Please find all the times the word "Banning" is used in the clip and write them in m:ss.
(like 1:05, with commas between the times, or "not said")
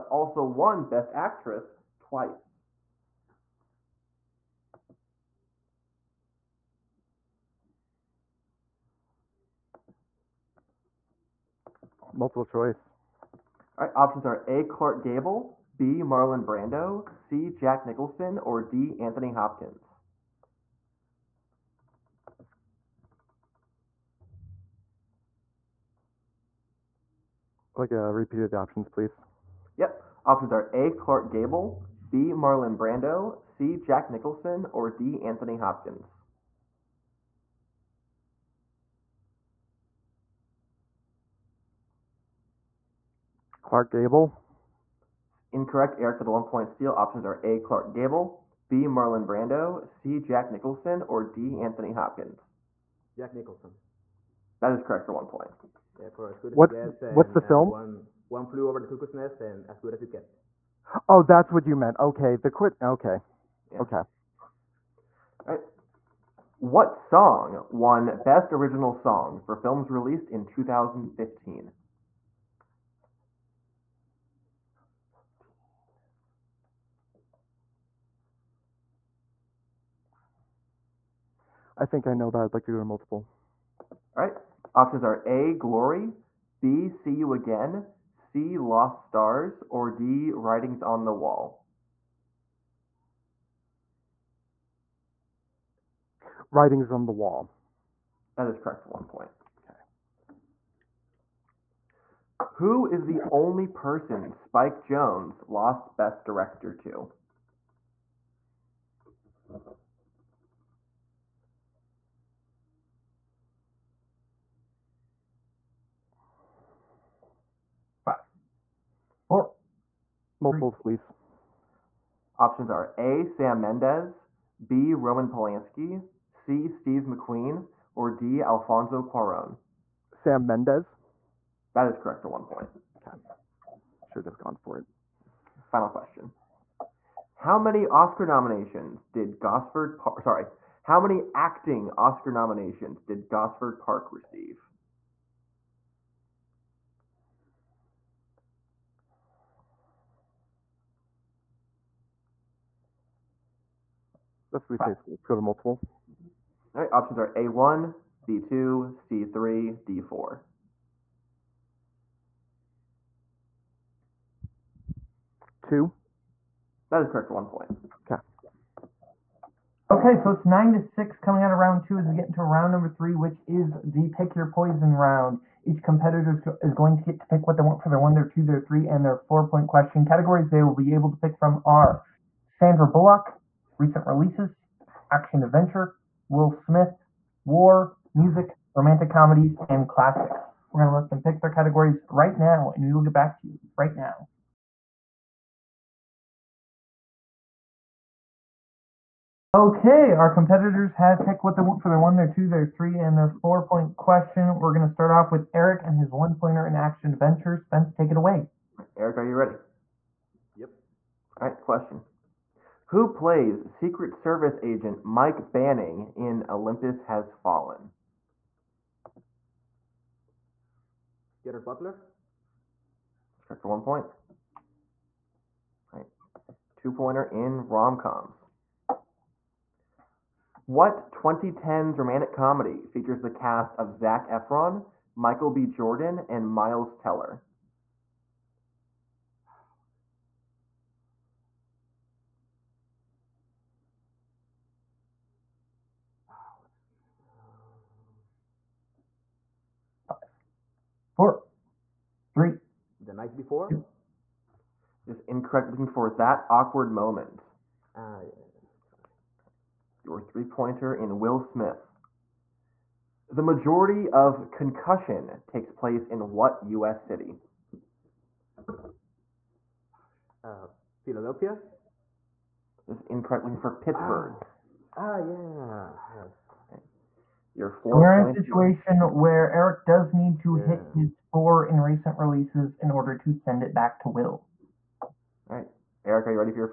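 3:35.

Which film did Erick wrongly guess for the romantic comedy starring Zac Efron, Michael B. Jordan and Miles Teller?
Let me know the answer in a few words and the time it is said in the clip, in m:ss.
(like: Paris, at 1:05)
The Night Before, at 4:13.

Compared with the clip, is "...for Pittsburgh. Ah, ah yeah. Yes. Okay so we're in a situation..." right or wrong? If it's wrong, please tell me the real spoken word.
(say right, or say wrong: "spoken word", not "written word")
right.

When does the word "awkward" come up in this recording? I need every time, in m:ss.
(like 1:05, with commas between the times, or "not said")
4:16.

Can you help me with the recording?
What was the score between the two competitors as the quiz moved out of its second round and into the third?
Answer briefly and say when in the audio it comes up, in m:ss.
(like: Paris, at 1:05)
9 to 6, at 2:50.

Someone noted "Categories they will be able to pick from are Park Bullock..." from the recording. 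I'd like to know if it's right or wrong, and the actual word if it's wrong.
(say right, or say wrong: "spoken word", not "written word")
wrong: "Sandra", not "Park".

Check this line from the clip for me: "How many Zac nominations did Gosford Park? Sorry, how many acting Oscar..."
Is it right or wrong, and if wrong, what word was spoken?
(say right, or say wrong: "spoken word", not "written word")
wrong: "Oscar", not "Zac".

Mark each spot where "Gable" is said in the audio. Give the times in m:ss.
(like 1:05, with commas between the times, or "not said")
0:15, 0:31, 0:43, 0:47.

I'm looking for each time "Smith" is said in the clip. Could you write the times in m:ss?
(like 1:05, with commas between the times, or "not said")
3:06, 4:21.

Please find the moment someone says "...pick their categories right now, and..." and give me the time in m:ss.
3:11.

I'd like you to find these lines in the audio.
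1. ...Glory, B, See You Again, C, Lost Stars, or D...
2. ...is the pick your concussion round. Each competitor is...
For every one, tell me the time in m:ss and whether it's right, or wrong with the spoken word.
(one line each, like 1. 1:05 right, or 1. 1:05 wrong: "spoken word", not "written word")
1. 1:25 right
2. 2:53 wrong: "poison", not "concussion".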